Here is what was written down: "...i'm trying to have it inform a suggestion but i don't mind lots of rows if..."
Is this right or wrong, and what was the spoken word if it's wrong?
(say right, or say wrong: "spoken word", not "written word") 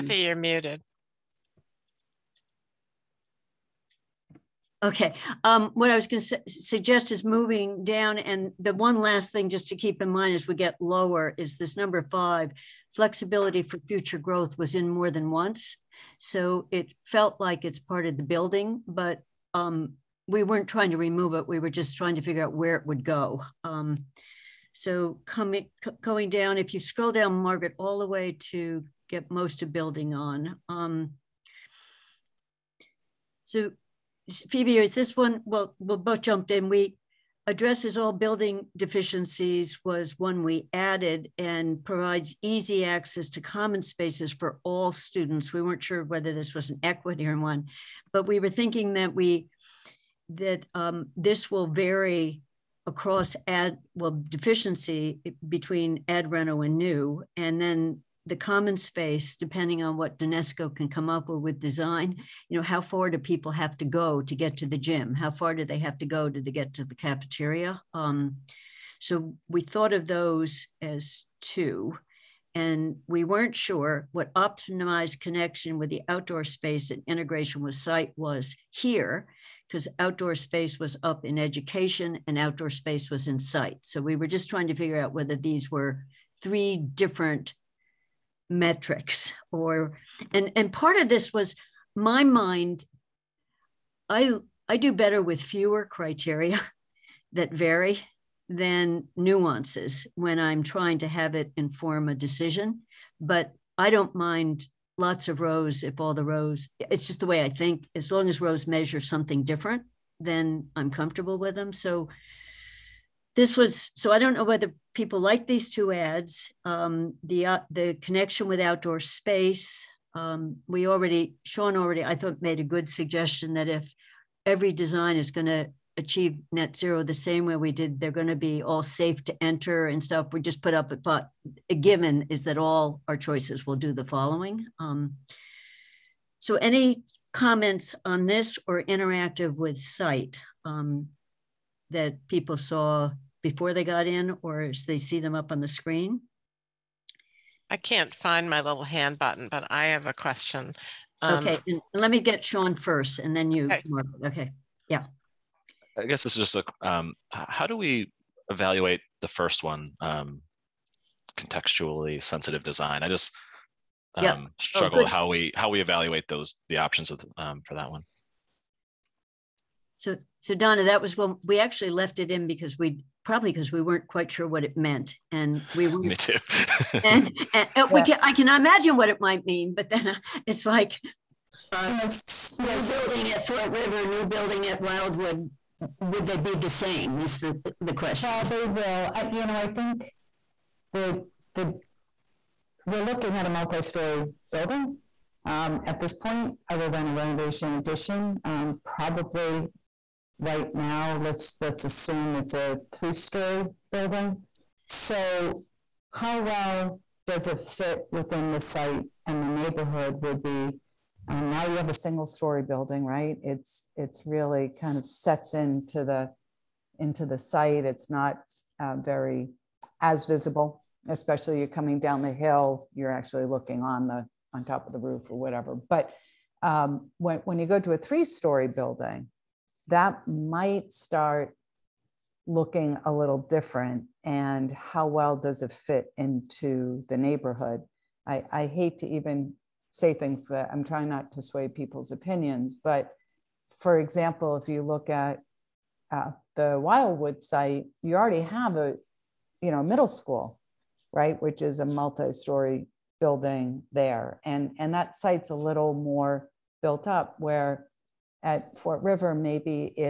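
wrong: "decision", not "suggestion".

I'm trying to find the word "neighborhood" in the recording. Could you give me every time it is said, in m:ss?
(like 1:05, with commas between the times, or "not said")
3:29, 3:57.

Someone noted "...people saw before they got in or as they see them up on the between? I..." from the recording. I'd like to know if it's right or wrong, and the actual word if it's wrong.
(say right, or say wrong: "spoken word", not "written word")
wrong: "screen", not "between".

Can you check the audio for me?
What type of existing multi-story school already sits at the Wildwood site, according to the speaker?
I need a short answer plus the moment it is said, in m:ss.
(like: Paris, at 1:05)
Middle school, at 4:09.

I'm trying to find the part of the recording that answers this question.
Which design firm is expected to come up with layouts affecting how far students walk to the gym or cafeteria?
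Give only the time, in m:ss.
1:00.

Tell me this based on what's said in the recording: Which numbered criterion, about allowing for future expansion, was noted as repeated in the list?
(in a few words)
Number 5.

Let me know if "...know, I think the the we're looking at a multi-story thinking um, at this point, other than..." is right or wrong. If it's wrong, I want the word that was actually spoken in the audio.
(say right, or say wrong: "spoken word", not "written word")
wrong: "building", not "thinking".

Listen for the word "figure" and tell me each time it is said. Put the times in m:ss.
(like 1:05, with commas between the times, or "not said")
0:22, 1:24.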